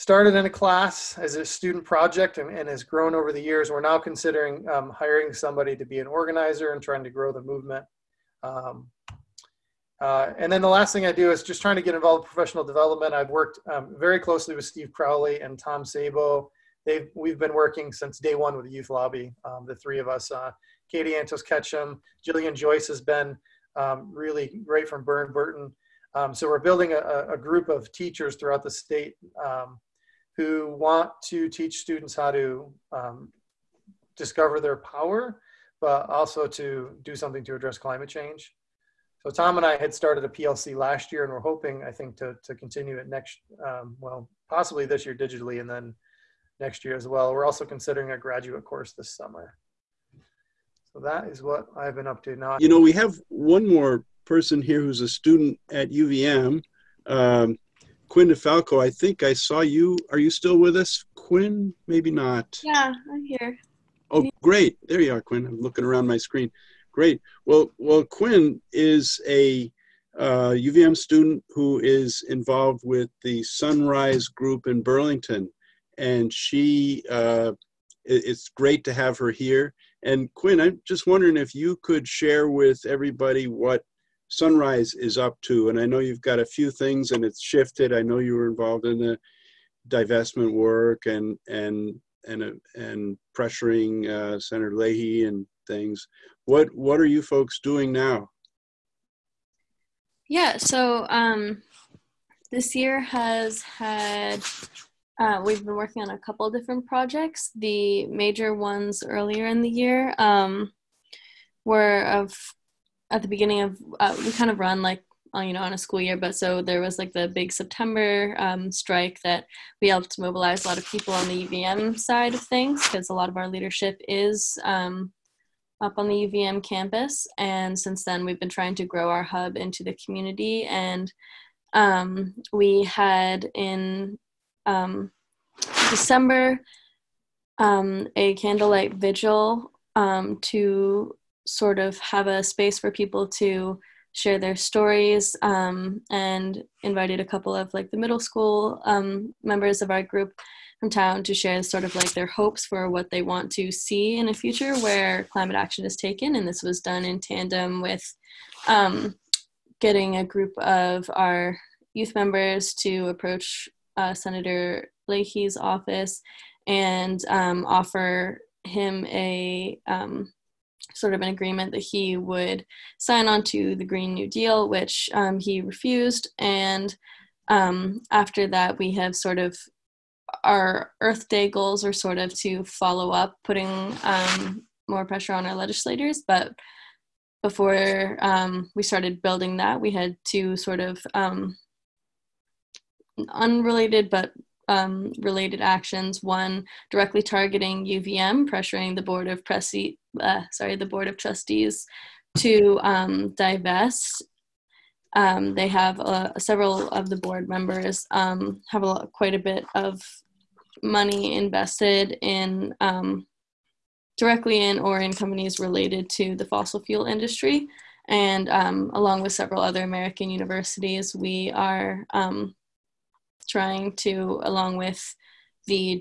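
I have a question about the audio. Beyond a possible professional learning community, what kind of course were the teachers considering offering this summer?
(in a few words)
graduate course.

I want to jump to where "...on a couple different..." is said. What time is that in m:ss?
1:46.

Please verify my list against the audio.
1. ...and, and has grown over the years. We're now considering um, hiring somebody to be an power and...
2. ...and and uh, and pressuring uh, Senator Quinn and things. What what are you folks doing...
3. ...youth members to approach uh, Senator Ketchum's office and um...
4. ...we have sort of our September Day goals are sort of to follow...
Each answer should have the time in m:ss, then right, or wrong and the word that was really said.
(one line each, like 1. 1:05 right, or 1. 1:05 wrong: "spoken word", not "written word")
1. 0:02 wrong: "organizer", not "power"
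2. 1:31 wrong: "Leahy", not "Quinn"
3. 2:41 wrong: "Leahy", not "Ketchum"
4. 2:58 wrong: "Earth", not "September".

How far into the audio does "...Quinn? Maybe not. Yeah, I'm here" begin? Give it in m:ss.
1:01.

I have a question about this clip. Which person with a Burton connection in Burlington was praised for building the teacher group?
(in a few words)
Jillian Joyce.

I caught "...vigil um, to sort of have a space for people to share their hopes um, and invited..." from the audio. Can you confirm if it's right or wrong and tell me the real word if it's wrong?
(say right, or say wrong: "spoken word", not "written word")
wrong: "stories", not "hopes".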